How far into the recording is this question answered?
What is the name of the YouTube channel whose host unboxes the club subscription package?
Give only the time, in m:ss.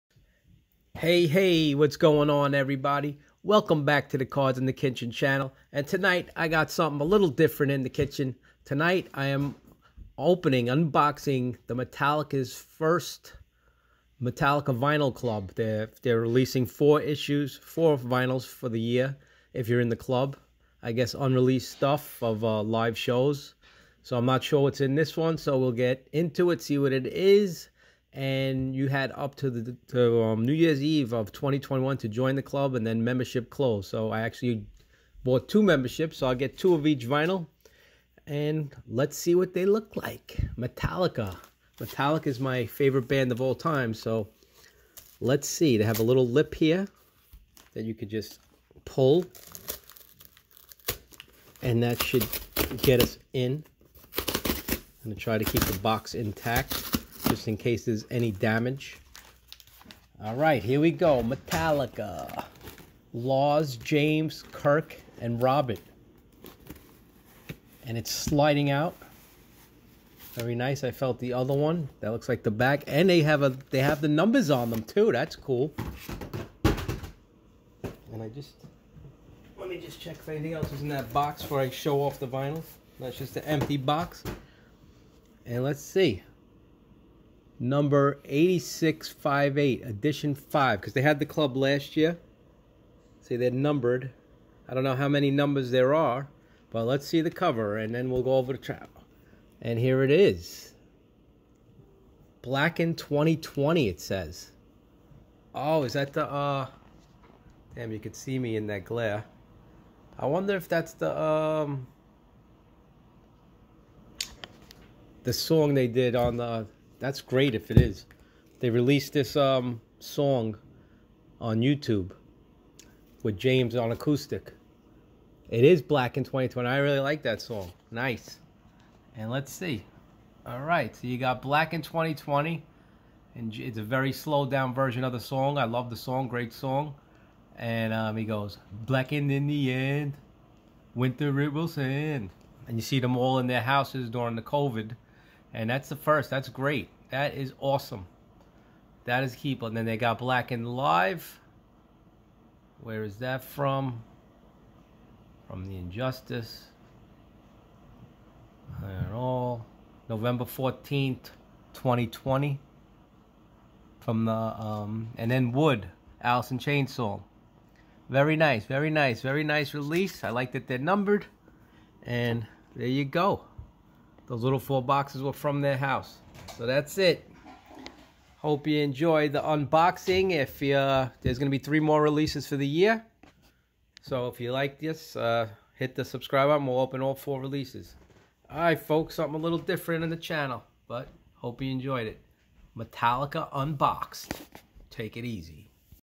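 0:04.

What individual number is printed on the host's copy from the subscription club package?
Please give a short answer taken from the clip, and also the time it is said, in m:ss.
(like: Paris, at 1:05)
8658, at 1:28.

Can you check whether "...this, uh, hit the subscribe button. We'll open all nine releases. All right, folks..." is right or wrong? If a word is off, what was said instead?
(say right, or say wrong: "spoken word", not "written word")
wrong: "four", not "nine".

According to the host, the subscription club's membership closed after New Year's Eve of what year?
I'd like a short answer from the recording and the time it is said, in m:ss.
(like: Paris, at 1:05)
2021, at 0:31.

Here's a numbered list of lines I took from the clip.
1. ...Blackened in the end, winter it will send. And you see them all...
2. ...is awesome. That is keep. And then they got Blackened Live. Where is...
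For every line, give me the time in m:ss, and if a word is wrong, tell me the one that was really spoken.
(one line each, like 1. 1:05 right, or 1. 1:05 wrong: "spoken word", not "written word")
1. 2:18 right
2. 2:27 right.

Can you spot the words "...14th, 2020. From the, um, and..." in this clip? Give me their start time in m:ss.
2:40.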